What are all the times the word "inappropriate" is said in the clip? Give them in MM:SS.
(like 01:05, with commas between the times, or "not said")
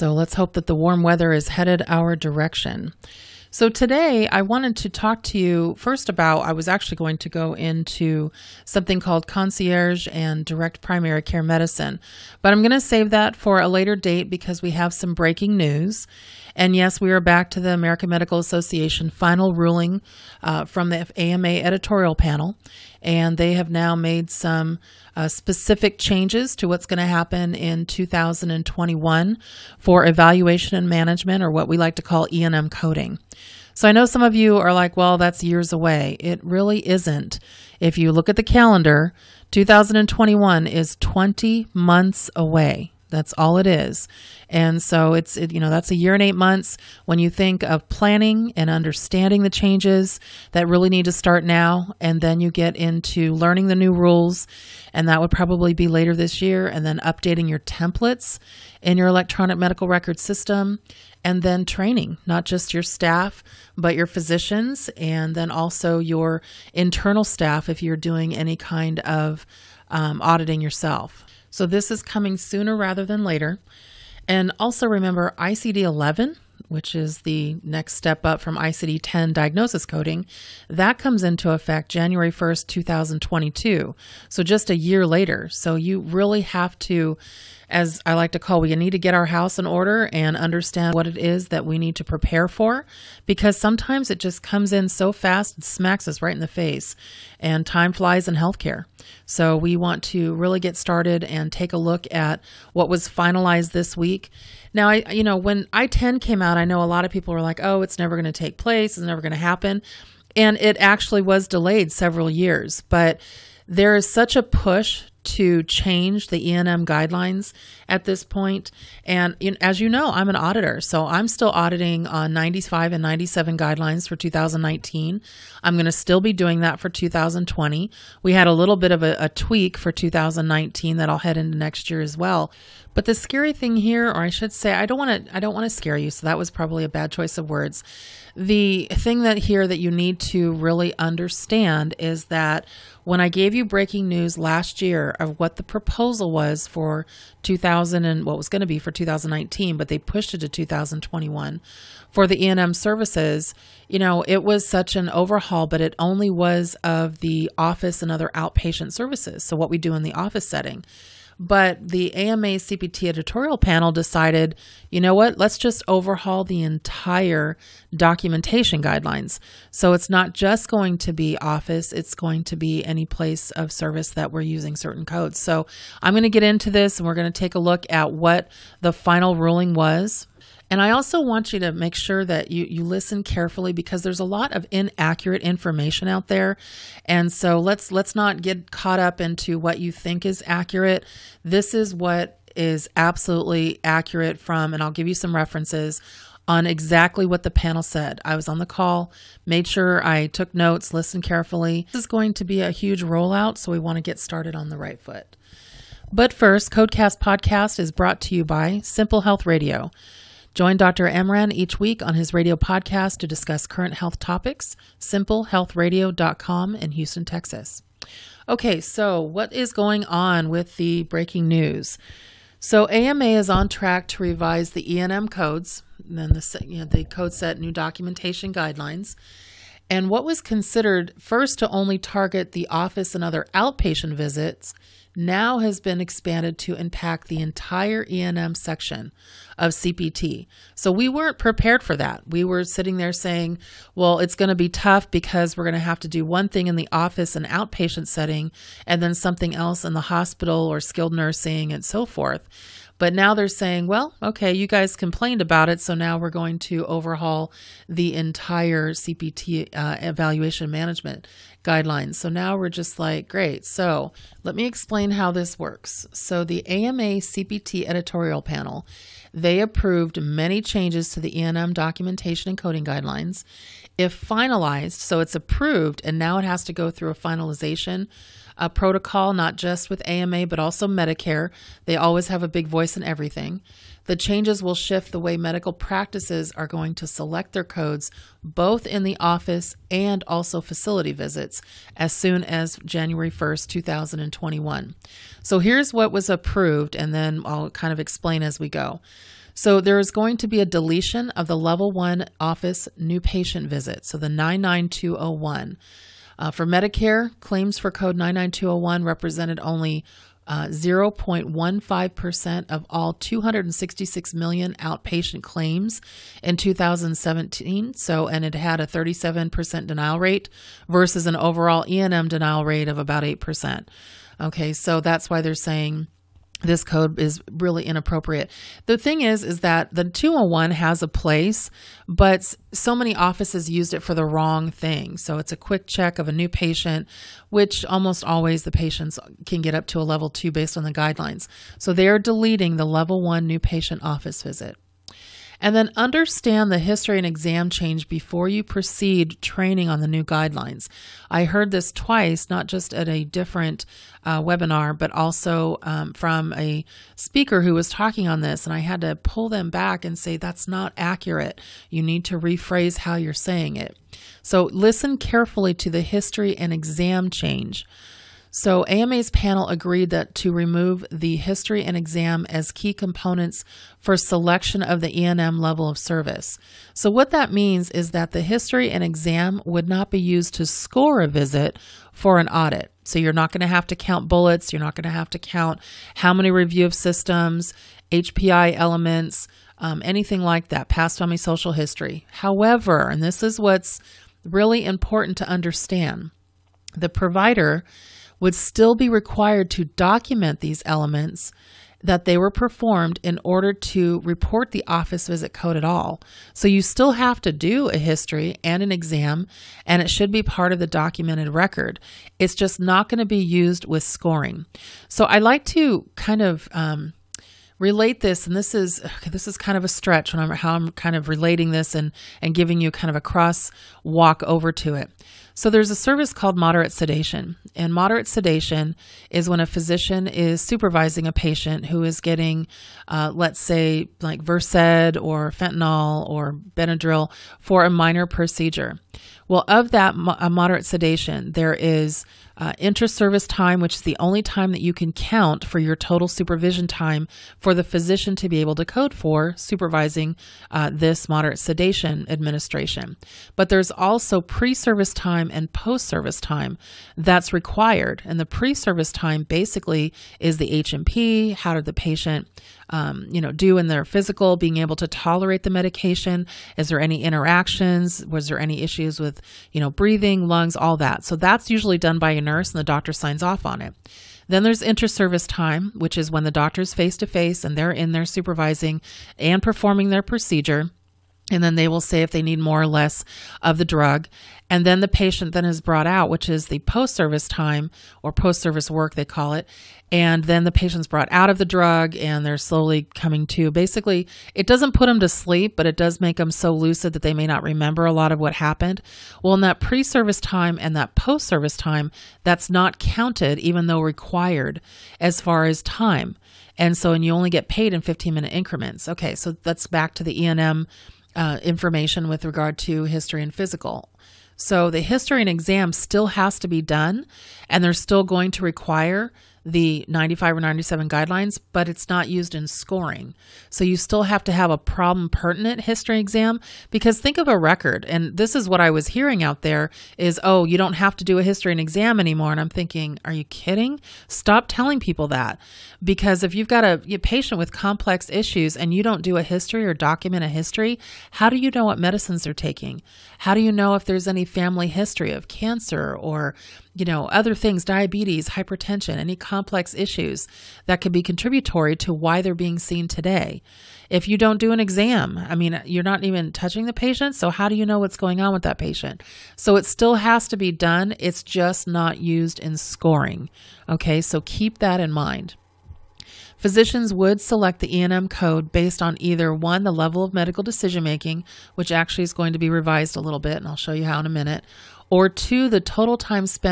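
05:27.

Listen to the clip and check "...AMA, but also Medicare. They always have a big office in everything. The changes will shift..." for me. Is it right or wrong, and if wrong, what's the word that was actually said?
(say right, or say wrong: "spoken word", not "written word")
wrong: "voice", not "office".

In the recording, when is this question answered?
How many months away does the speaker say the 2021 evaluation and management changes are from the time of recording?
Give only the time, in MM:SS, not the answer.
00:41.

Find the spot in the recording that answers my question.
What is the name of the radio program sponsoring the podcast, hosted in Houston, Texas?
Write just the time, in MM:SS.
03:28.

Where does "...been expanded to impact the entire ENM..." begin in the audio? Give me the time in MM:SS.
03:55.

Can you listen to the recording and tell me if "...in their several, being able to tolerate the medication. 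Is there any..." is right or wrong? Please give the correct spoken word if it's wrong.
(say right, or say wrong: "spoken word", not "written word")
wrong: "physical", not "several".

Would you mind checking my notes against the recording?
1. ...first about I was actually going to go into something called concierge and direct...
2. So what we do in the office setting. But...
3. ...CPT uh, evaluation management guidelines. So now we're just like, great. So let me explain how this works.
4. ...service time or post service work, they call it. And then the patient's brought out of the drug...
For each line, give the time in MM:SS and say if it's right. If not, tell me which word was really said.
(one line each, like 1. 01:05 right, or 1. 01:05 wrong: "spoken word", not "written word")
1. 00:05 right
2. 02:39 right
3. 04:18 right
4. 08:07 right.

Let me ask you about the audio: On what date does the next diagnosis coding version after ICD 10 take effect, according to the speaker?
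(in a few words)
January 1st, 2022.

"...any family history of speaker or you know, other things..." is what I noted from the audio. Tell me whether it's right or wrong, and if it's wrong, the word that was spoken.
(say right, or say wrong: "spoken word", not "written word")
wrong: "cancer", not "speaker".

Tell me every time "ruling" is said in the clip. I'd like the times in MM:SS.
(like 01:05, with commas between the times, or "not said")
00:19, 02:59.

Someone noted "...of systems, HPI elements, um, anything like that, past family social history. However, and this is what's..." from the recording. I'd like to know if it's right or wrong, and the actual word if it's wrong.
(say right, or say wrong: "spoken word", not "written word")
right.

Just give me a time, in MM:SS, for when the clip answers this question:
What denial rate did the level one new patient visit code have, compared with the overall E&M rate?
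05:18.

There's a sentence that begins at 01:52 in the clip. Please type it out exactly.
But there is such a push to change the ENM guidelines at this point.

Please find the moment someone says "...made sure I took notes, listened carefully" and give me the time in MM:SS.
03:19.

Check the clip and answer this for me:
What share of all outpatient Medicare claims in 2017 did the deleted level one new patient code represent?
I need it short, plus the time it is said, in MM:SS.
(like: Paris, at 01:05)
0.15%, at 05:10.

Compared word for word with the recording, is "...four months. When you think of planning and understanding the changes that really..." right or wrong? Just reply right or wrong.
wrong.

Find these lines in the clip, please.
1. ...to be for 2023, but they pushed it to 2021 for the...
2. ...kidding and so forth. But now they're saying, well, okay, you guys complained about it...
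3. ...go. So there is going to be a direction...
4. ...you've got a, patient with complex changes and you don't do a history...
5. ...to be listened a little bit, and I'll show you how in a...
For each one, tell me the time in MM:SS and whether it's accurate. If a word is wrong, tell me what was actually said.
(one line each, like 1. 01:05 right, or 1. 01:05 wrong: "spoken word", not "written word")
1. 02:28 wrong: "2019", not "2023"
2. 04:11 wrong: "nursing", not "kidding"
3. 04:58 wrong: "deletion", not "direction"
4. 08:56 wrong: "issues", not "changes"
5. 09:32 wrong: "revised", not "listened".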